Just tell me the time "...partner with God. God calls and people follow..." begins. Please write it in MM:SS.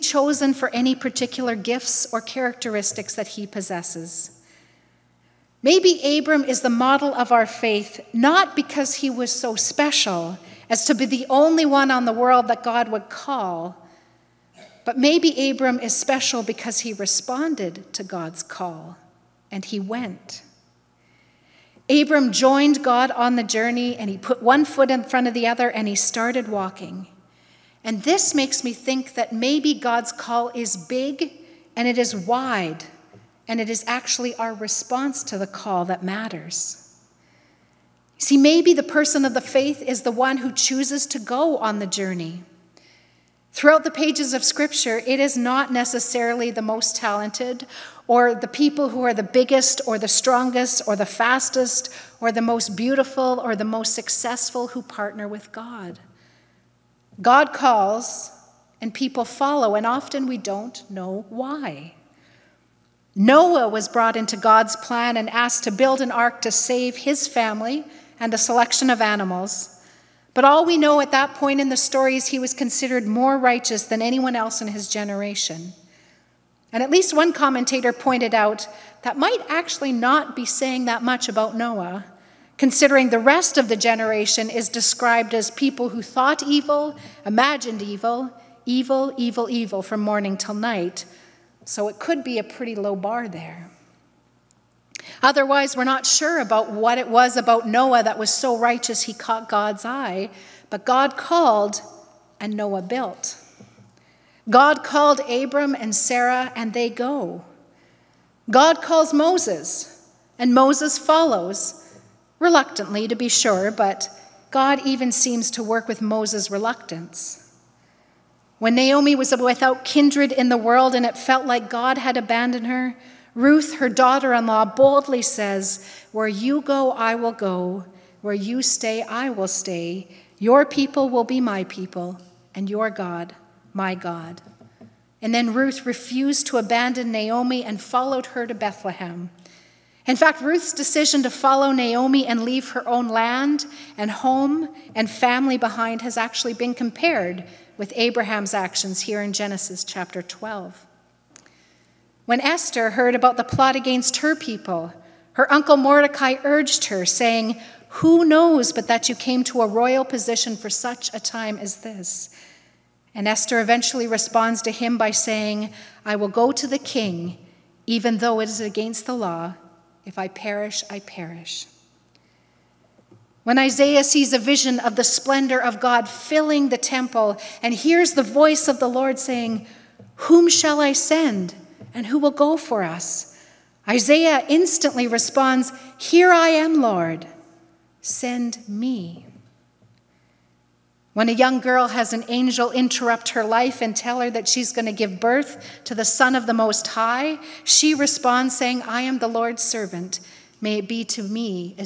00:54.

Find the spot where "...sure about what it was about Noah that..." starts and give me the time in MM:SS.
01:36.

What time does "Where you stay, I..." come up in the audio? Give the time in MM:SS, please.
02:08.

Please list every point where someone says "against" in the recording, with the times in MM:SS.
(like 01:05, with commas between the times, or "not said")
02:33, 02:48.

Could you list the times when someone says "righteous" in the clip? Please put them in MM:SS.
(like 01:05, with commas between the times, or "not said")
01:13, 01:38.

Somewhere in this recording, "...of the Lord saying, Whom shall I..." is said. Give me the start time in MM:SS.
02:58.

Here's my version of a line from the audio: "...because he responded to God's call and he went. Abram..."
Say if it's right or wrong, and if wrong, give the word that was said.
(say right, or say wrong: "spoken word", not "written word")
right.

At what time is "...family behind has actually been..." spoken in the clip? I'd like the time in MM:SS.
02:25.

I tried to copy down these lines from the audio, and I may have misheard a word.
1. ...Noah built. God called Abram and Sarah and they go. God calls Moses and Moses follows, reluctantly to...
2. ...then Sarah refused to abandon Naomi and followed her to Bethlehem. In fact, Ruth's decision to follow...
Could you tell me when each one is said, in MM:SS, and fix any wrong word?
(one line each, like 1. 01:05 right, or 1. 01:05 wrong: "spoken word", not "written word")
1. 01:42 right
2. 02:15 wrong: "Ruth", not "Sarah".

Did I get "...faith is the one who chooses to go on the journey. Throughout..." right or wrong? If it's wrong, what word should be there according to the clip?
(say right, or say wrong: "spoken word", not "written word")
right.